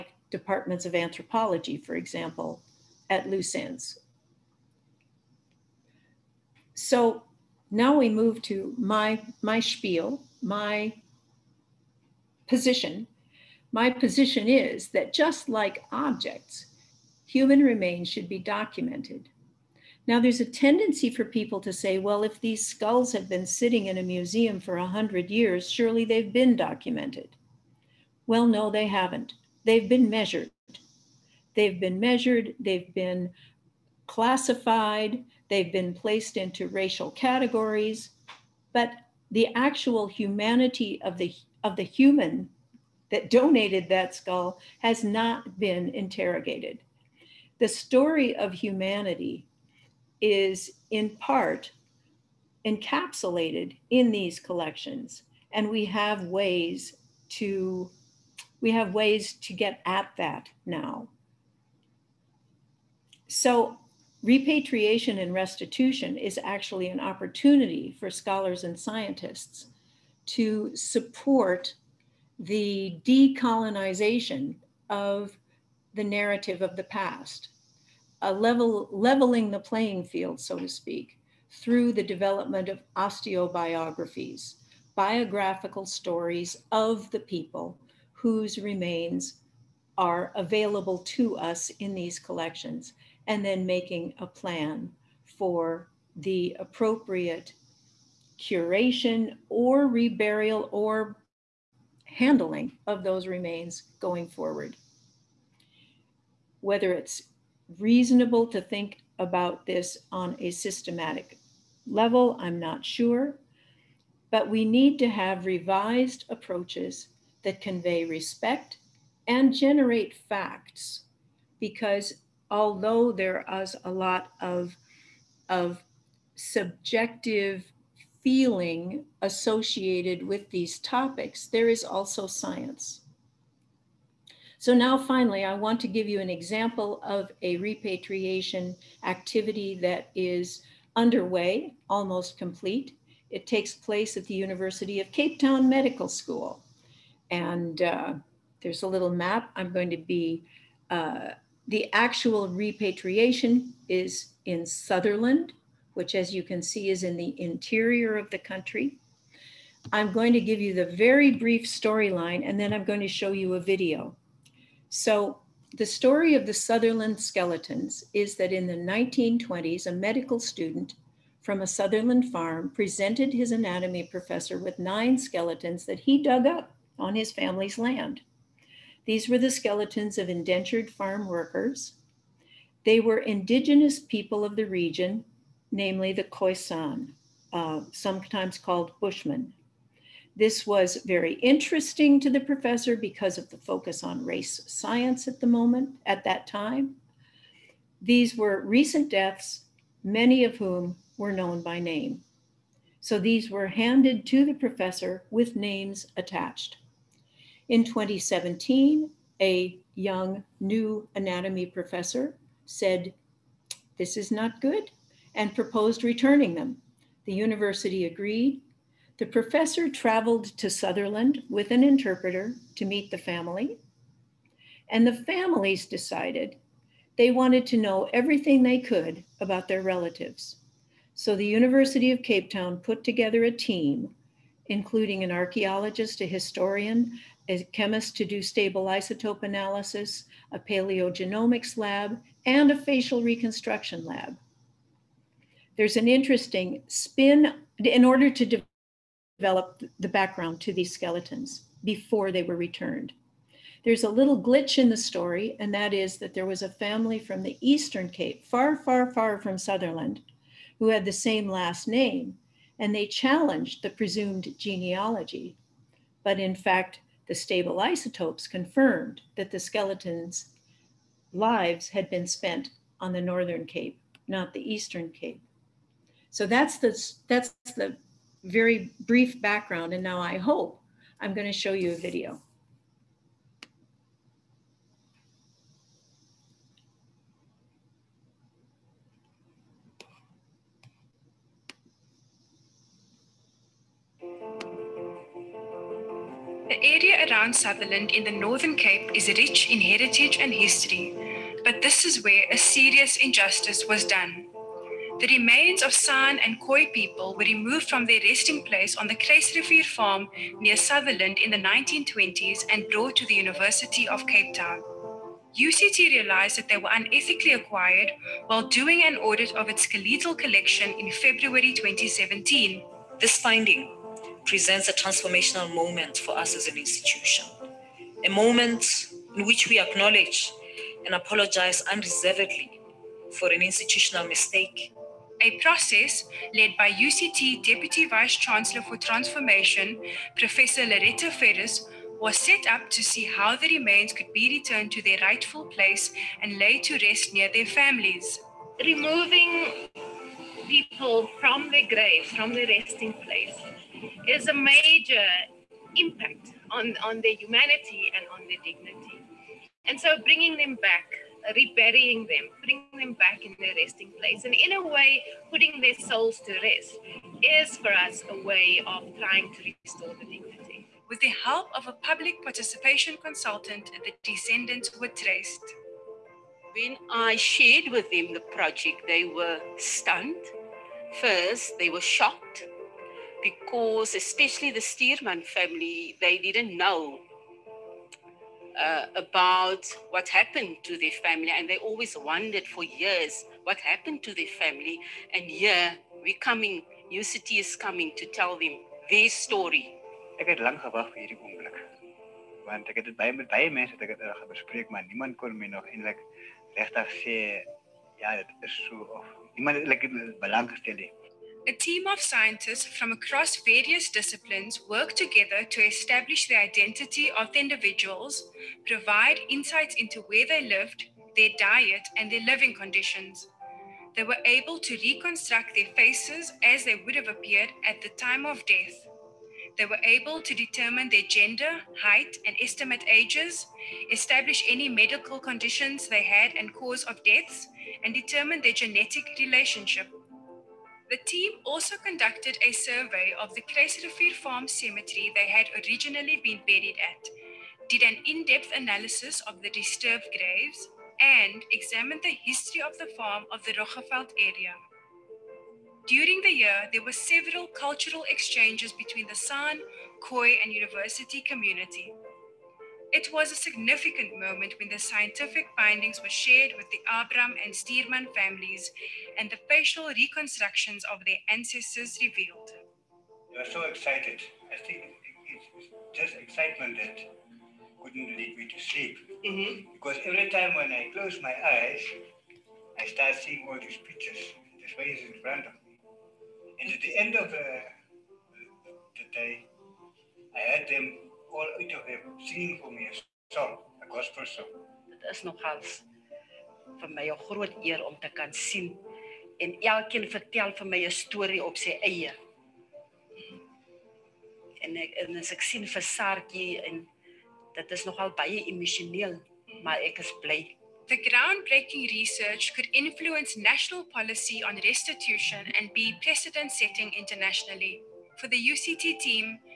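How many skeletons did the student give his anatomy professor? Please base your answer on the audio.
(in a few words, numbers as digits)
9.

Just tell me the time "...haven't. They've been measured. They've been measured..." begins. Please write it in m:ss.
0:28.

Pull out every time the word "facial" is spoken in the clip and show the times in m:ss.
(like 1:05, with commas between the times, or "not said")
4:02, 7:49.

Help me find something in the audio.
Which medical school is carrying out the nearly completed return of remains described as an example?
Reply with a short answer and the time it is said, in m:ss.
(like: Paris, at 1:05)
University of Cape Town Medical School, at 2:24.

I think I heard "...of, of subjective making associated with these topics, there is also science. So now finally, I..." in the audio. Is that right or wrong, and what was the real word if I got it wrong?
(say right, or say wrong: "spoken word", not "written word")
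wrong: "feeling", not "making".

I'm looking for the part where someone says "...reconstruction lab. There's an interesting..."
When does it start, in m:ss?
4:03.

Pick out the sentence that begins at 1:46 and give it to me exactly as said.
Whether it's reasonable to think about this on a systematic level.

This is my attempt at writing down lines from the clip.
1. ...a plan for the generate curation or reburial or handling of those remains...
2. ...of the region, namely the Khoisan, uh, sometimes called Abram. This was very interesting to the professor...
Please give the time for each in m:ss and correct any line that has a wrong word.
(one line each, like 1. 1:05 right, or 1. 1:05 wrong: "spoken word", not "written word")
1. 1:34 wrong: "appropriate", not "generate"
2. 3:04 wrong: "Bushmen", not "Abram".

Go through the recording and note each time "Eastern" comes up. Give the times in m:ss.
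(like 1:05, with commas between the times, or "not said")
4:17, 4:34.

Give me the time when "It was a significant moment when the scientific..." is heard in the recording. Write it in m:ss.
7:43.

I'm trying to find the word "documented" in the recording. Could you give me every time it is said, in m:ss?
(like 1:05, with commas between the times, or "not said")
0:18, 0:26.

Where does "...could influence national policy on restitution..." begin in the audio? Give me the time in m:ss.
8:32.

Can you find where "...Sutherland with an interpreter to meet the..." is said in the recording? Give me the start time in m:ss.
3:40.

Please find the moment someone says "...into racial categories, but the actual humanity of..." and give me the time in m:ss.
0:36.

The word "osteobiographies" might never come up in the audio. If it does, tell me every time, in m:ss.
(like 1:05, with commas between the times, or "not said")
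1:22.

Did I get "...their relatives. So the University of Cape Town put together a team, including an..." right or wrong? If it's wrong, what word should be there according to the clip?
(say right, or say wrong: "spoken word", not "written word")
right.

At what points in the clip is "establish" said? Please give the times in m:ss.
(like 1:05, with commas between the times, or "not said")
6:55, 7:14.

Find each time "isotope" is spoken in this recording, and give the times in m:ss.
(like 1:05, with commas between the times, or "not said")
3:58, 4:27.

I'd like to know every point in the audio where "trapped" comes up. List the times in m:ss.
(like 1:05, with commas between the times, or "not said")
not said.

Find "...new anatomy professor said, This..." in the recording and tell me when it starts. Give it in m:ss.
3:30.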